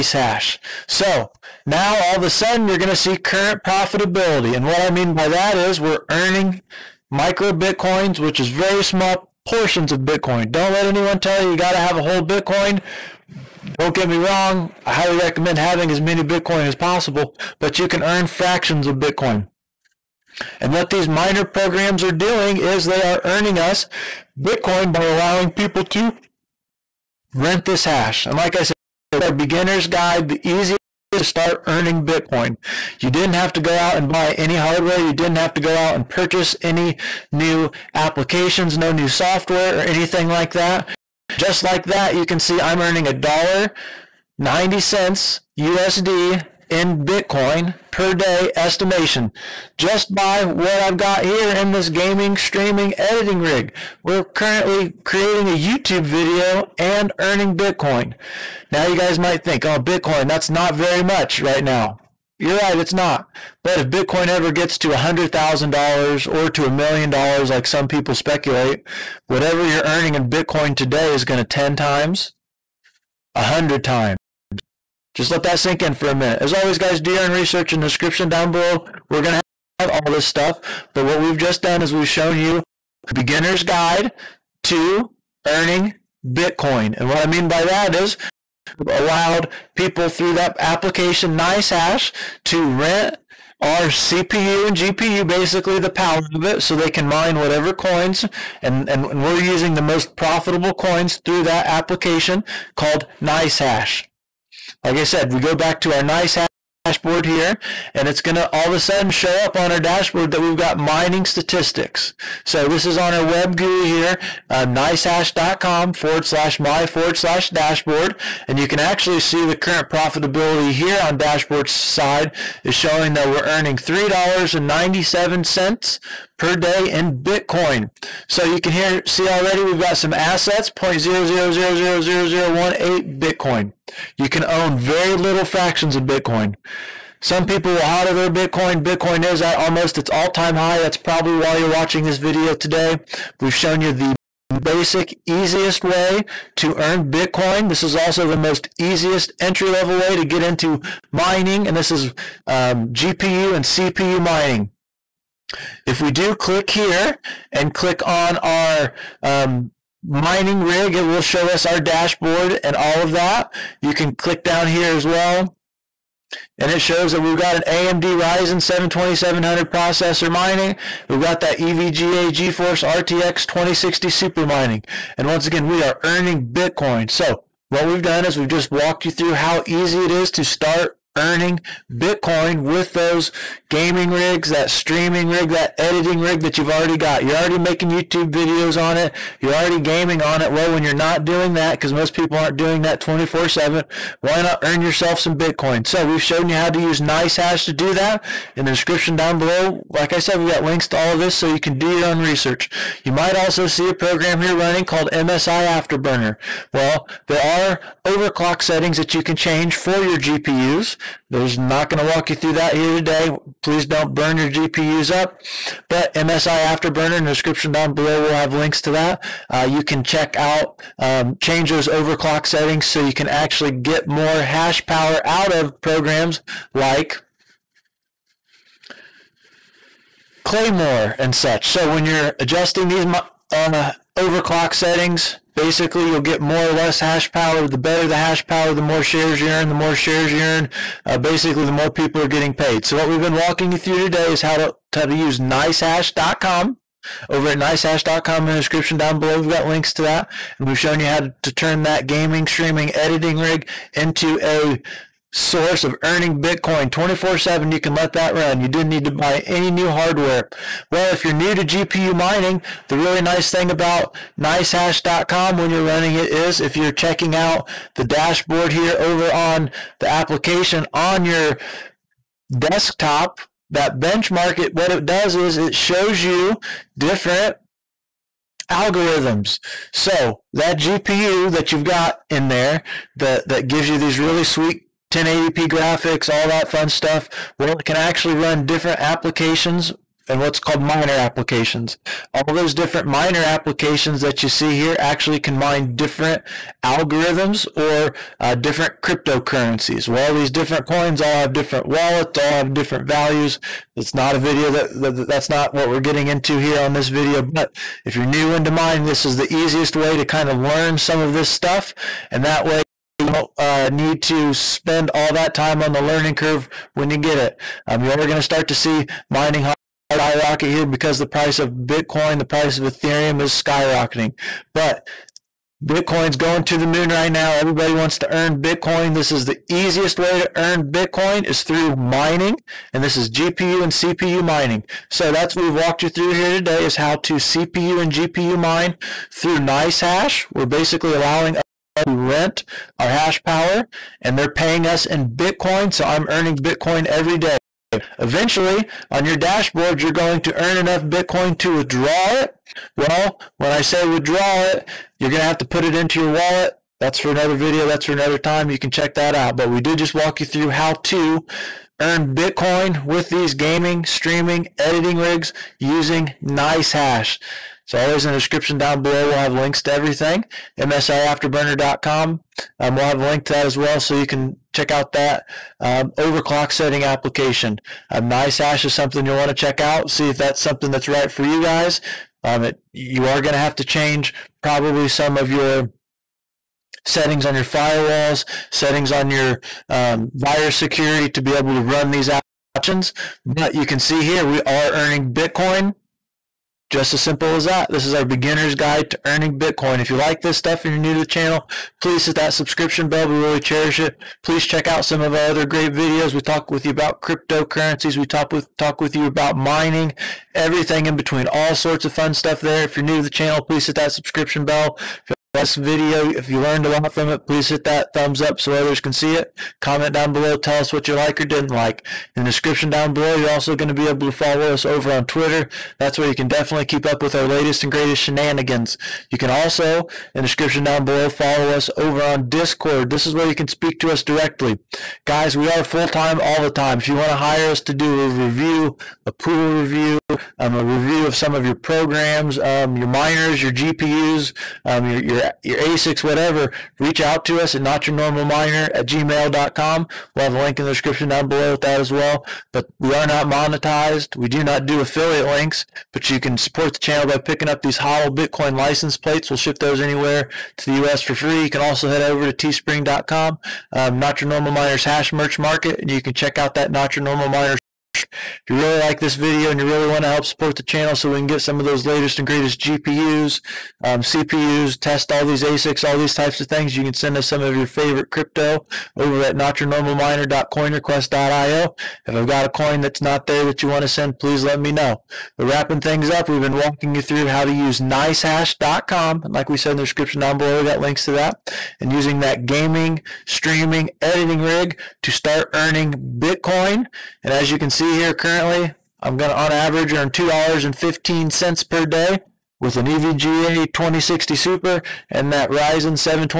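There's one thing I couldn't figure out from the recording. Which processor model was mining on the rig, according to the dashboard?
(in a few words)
AMD Ryzen 7 2700.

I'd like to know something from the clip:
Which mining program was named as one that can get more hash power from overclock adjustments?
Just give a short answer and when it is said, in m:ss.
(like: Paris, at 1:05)
Claymore, at 3:50.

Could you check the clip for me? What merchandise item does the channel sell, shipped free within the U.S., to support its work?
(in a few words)
HODL Bitcoin license plates.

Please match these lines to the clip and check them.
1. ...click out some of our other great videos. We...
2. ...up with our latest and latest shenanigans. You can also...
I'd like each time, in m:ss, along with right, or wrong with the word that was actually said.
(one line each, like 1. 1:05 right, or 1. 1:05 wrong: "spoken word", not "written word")
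1. 6:44 wrong: "check", not "click"
2. 7:07 wrong: "greatest", not "latest".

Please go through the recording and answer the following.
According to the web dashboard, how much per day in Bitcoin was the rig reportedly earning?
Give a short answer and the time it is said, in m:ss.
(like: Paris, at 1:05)
$3.97, at 2:03.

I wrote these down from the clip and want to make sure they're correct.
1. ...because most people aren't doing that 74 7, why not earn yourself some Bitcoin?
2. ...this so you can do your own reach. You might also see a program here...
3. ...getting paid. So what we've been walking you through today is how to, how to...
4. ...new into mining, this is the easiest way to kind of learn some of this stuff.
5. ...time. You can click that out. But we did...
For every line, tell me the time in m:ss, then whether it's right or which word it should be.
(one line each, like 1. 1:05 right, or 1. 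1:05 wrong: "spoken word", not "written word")
1. 3:11 wrong: "24", not "74"
2. 3:21 wrong: "research", not "reach"
3. 4:02 right
4. 5:08 right
5. 5:58 wrong: "check", not "click".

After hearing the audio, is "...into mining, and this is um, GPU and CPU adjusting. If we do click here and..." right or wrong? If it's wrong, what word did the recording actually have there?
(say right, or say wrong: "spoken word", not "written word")
wrong: "mining", not "adjusting".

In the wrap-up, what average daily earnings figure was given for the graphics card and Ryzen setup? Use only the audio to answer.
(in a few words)
$2.15.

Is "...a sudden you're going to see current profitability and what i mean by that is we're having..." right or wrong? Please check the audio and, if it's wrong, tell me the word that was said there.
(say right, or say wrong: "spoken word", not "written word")
wrong: "earning", not "having".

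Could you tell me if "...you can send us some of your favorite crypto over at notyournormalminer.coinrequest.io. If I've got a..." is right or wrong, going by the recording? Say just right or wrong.
right.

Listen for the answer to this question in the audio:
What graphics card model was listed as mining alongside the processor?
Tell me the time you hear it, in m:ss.
2:51.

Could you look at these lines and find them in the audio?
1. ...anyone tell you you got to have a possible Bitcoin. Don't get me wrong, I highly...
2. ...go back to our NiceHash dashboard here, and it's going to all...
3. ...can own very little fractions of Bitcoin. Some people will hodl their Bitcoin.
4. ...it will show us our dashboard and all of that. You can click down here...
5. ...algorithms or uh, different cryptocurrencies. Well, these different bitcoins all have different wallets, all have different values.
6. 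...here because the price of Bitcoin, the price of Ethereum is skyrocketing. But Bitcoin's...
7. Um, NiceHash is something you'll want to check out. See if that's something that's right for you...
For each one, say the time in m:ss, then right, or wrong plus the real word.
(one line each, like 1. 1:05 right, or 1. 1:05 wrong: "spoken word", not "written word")
1. 0:10 wrong: "whole", not "possible"
2. 1:45 right
3. 2:14 right
4. 2:40 right
5. 4:56 wrong: "coins", not "bitcoins"
6. 5:20 right
7. 6:18 right.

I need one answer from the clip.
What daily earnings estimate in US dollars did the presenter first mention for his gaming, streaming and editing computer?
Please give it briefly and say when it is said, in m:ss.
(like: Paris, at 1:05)
$1.90, at 0:43.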